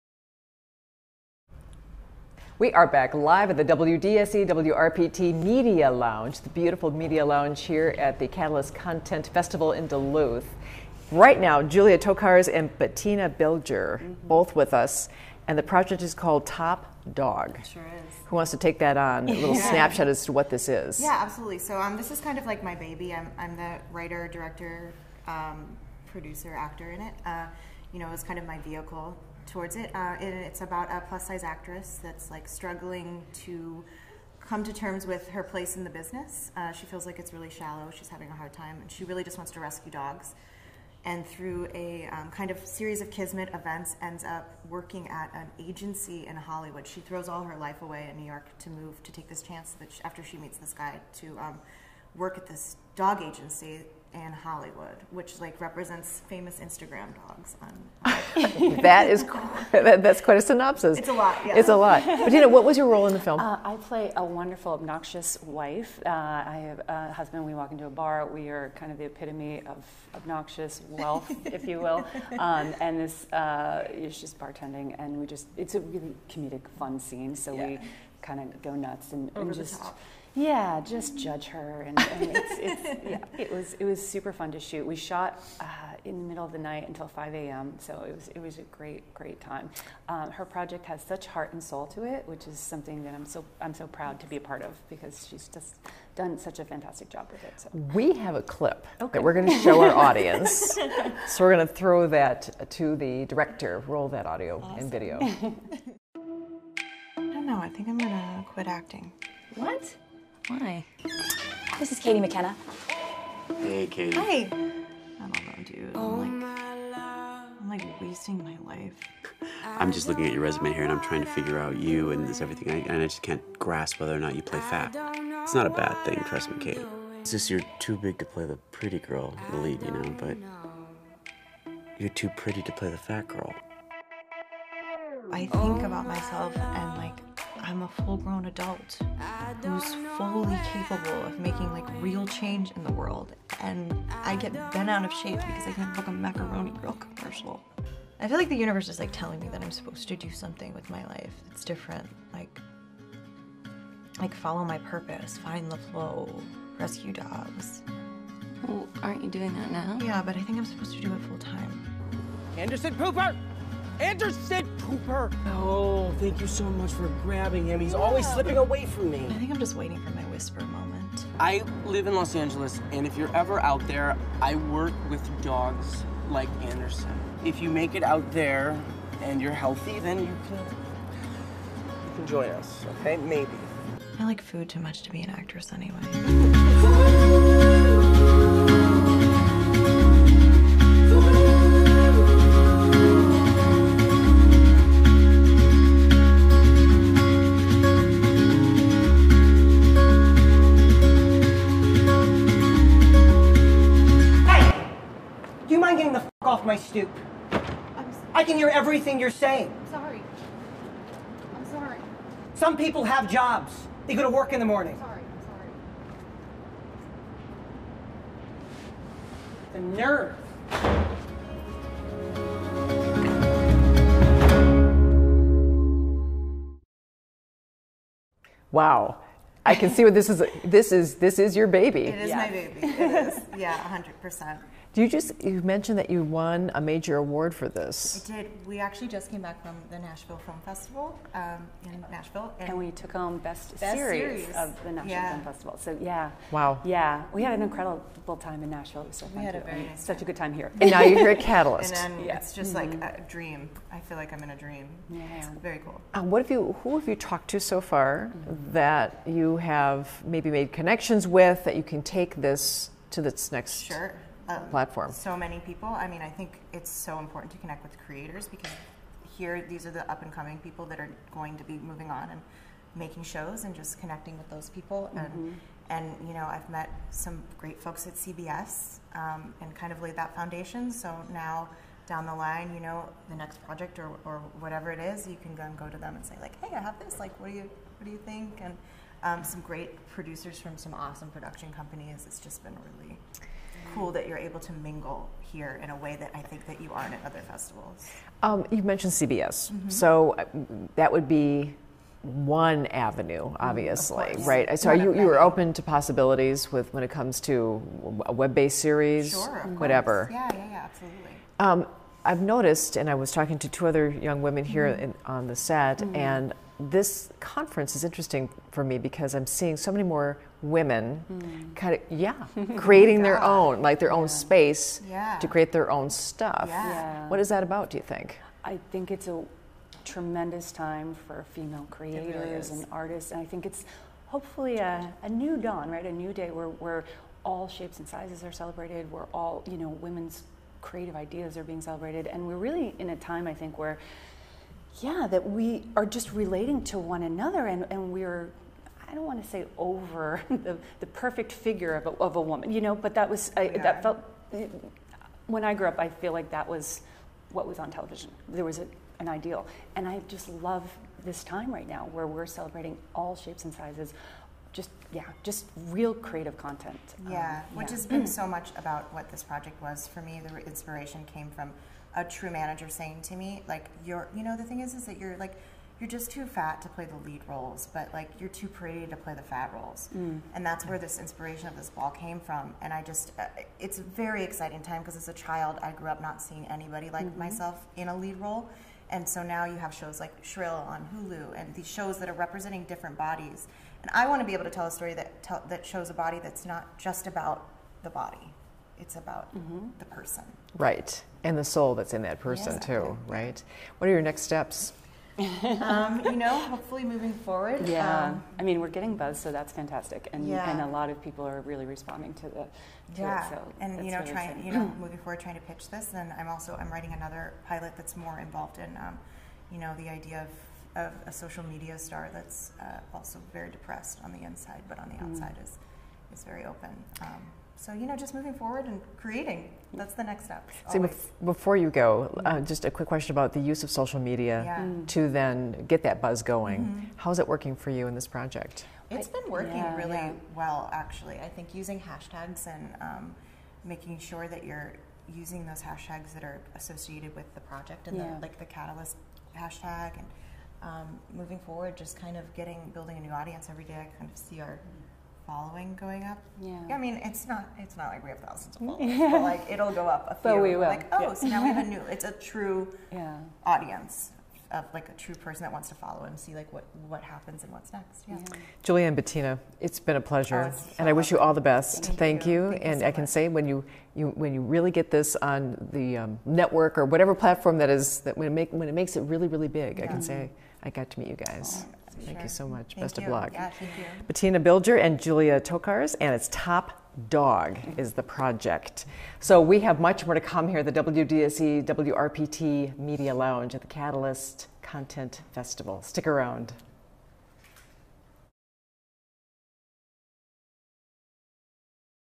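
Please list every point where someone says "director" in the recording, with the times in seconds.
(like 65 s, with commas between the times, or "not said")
24 s, 103 s.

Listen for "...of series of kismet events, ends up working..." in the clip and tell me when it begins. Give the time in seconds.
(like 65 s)
42 s.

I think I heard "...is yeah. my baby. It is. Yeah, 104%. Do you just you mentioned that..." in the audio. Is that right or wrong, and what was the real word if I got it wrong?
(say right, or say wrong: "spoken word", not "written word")
wrong: "100", not "104".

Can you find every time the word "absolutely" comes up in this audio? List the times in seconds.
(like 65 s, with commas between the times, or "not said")
21 s, 310 s.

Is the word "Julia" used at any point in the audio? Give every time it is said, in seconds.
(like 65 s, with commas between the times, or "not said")
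11 s, 468 s, 485 s.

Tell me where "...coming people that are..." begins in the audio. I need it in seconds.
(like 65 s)
270 s.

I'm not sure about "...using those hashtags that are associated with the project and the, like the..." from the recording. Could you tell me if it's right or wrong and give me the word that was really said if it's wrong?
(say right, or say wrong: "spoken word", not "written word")
right.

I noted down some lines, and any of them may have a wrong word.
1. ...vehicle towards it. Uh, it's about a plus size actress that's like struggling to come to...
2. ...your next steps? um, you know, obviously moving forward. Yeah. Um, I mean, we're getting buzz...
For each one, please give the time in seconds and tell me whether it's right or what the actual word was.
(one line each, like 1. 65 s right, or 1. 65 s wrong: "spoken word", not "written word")
1. 28 s right
2. 404 s wrong: "hopefully", not "obviously".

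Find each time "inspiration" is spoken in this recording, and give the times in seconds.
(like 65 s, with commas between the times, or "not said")
370 s, 381 s.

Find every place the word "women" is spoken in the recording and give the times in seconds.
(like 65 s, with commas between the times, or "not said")
314 s, 320 s, 339 s.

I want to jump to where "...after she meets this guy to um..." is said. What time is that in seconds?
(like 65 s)
50 s.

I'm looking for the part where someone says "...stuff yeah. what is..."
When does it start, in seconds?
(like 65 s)
326 s.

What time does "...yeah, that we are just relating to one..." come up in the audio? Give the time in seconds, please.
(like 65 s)
344 s.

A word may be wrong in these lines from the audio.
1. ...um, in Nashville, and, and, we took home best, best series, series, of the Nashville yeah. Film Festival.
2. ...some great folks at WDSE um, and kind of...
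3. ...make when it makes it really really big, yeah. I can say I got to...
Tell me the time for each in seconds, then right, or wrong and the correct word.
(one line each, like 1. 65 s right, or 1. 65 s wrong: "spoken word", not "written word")
1. 241 s right
2. 277 s wrong: "CBS", not "WDSE"
3. 478 s right.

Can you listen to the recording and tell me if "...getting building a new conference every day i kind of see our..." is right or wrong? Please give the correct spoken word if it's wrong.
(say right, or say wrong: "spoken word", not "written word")
wrong: "audience", not "conference".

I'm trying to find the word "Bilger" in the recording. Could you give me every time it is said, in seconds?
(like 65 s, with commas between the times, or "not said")
13 s, 484 s.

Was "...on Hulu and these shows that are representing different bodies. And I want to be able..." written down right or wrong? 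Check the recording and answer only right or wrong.
right.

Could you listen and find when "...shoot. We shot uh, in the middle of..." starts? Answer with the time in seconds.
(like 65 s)
84 s.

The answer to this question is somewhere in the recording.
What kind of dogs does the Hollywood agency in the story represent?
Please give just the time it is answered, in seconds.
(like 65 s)
56 s.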